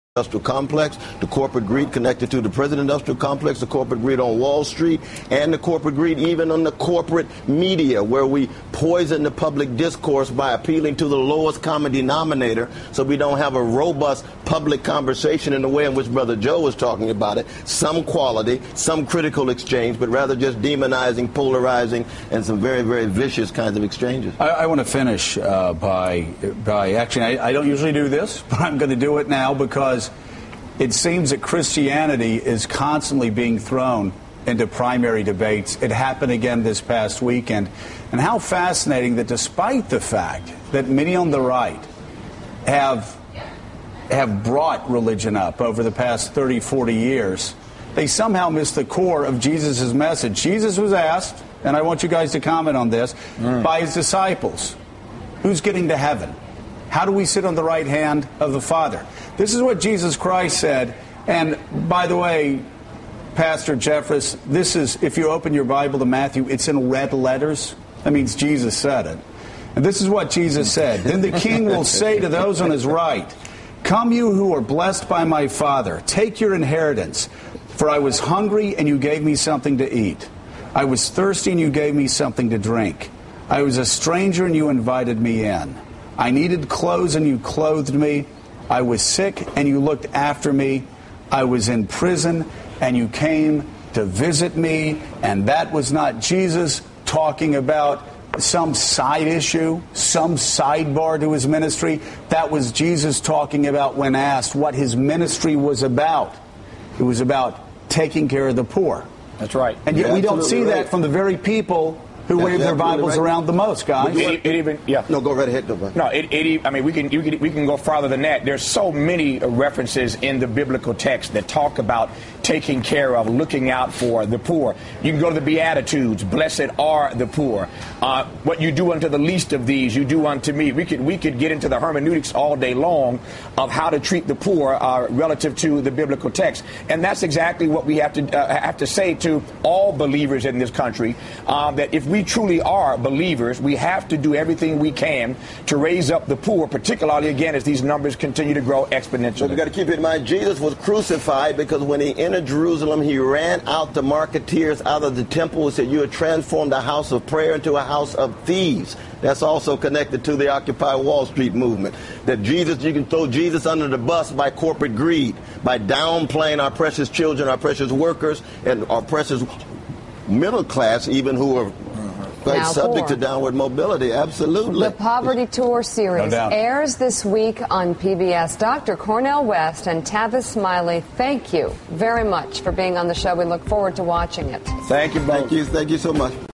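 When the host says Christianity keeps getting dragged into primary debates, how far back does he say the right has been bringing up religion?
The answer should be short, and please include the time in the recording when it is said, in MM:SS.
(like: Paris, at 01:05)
30, 40 years, at 00:46.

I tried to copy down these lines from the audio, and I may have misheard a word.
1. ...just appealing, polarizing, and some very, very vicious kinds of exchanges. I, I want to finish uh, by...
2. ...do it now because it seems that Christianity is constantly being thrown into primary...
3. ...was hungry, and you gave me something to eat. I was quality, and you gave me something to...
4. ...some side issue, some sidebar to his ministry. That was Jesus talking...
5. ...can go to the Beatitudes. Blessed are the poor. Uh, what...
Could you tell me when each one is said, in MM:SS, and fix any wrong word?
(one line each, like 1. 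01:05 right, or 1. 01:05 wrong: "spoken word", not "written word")
1. 00:20 wrong: "demonizing", not "appealing"
2. 00:28 right
3. 01:17 wrong: "thirsty", not "quality"
4. 01:38 right
5. 02:05 right.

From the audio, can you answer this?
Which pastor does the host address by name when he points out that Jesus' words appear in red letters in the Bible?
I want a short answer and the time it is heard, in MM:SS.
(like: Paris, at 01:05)
Pastor Jeffress, at 01:03.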